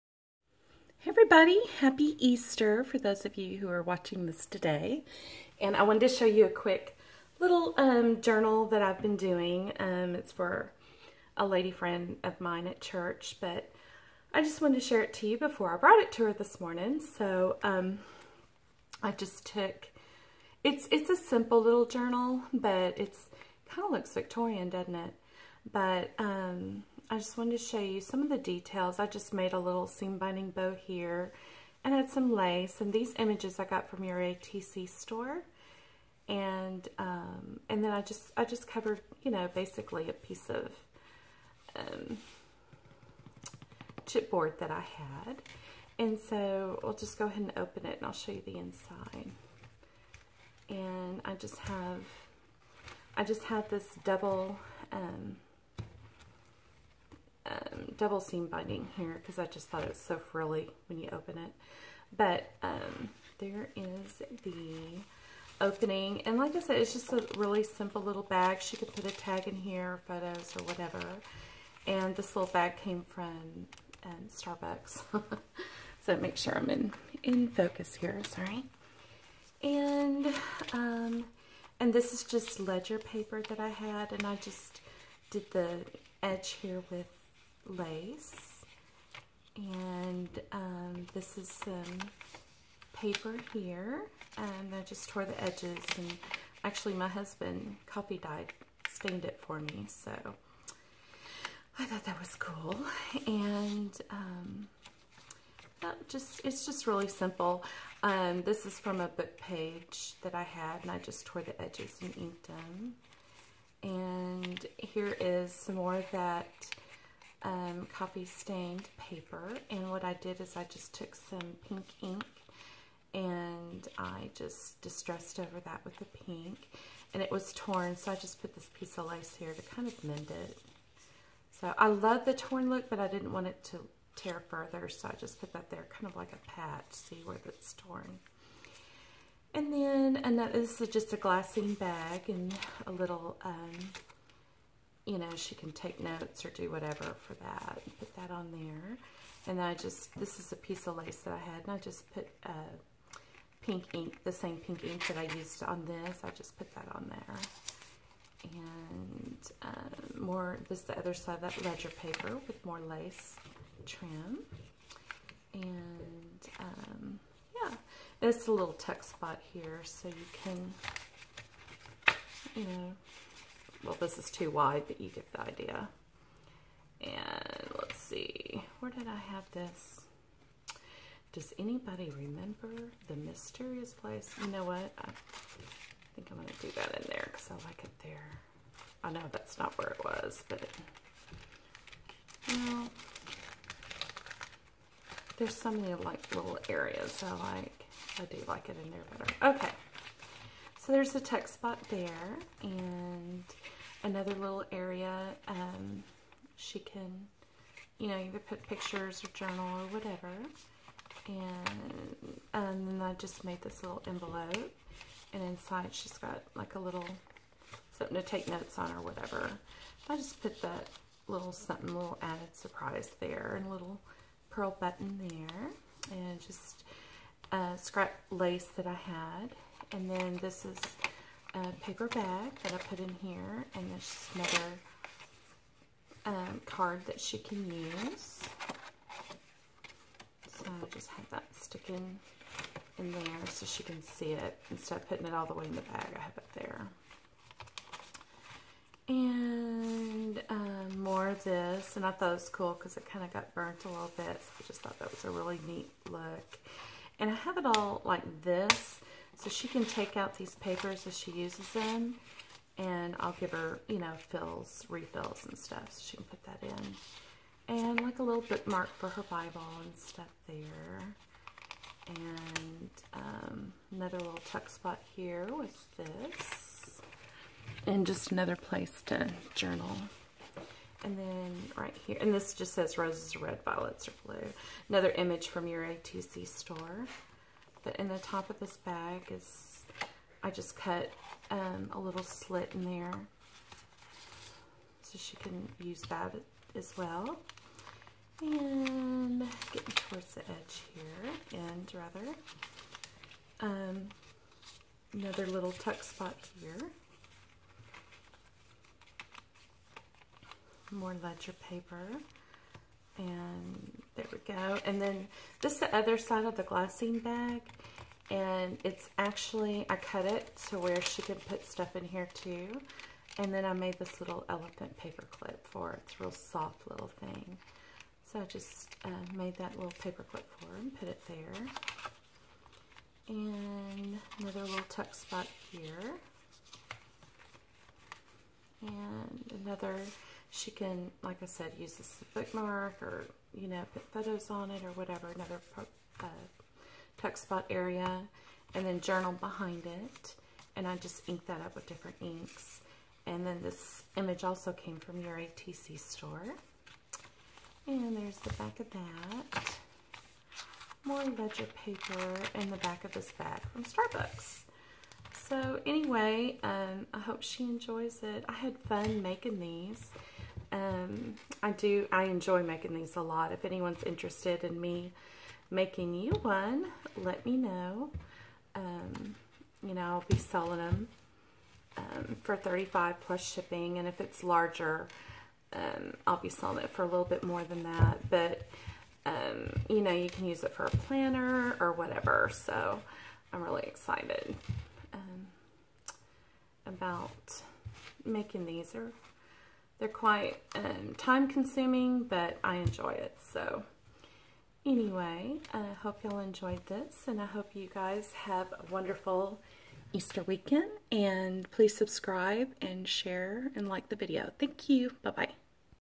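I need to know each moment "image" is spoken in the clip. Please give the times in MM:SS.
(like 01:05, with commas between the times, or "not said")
00:33, 04:45, 05:54.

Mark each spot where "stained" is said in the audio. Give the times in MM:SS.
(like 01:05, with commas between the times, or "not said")
01:38, 01:58.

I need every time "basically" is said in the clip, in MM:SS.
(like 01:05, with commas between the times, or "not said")
00:39.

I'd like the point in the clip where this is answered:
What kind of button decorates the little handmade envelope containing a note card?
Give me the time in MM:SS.
03:44.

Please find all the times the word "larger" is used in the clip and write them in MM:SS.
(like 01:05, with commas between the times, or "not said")
06:24.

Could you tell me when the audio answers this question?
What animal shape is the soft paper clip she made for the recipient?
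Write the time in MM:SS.
05:24.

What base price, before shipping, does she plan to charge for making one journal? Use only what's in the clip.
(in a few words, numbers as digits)
35.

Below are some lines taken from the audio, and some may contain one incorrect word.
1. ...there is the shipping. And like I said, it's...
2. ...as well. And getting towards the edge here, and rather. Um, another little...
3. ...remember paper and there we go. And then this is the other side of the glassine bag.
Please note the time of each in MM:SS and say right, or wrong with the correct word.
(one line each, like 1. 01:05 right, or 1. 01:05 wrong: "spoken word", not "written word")
1. 01:03 wrong: "opening", not "shipping"
2. 04:56 right
3. 05:11 wrong: "ledger", not "remember".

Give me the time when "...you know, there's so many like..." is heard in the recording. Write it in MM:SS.
03:12.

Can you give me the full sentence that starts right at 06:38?
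are they're quite um, time consuming, but I enjoy it.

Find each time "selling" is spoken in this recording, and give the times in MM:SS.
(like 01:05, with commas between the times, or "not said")
06:20, 06:26.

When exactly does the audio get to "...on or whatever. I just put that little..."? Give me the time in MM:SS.
03:38.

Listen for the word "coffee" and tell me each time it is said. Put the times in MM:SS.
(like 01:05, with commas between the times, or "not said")
01:37, 01:57.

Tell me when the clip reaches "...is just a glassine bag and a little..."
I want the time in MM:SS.
02:20.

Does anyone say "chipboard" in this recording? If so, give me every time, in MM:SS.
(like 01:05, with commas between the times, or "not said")
00:44.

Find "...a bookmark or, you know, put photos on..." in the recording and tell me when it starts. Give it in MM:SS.
05:42.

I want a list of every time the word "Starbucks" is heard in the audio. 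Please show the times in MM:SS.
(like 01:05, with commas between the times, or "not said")
01:14, 06:03.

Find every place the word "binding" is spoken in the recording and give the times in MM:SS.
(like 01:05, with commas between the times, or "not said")
00:30, 00:58.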